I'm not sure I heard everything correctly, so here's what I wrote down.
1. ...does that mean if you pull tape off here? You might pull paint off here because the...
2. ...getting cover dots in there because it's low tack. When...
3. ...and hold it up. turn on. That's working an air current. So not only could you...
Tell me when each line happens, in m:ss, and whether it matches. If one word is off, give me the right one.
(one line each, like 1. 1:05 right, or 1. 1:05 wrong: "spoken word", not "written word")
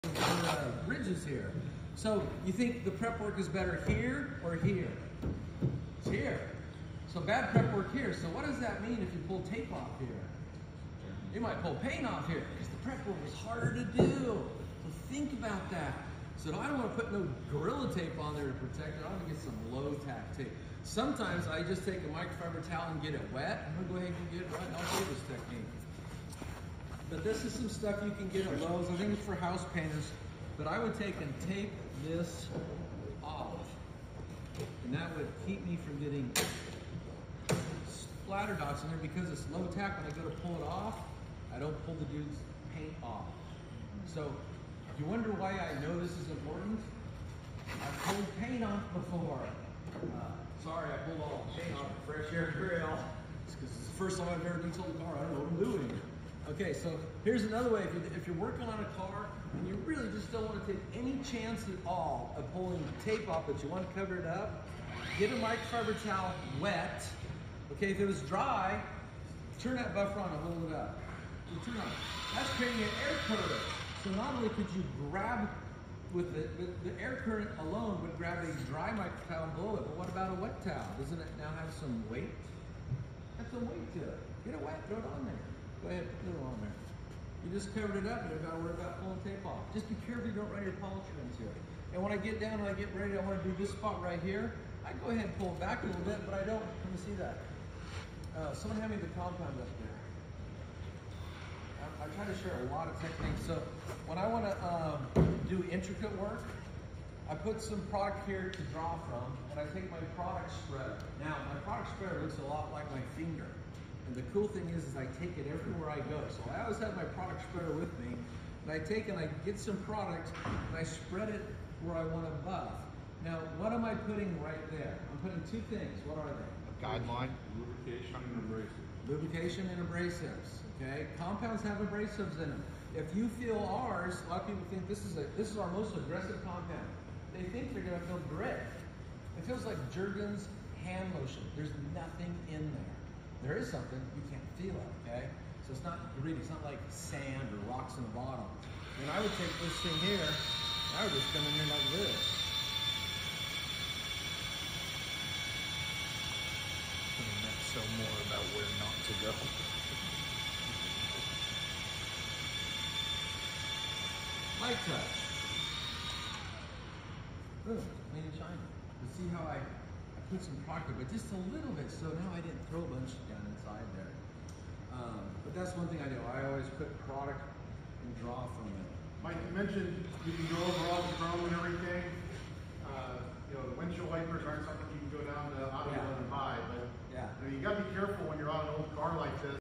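1. 0:08 right
2. 0:35 wrong: "splatter", not "cover"
3. 1:10 wrong: "creating", not "working".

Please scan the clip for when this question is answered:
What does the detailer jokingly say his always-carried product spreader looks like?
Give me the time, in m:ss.
1:53.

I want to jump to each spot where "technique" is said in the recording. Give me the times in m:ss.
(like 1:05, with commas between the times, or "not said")
0:25, 1:42.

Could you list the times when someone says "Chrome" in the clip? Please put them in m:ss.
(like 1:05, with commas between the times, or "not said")
3:01.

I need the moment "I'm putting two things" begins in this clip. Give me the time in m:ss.
2:05.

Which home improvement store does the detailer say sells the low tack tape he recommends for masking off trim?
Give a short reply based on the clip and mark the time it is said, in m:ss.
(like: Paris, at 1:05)
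Lowe's, at 0:28.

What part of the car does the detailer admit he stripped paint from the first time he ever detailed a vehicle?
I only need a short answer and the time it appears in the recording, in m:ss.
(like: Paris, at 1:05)
fresh air grill, at 0:52.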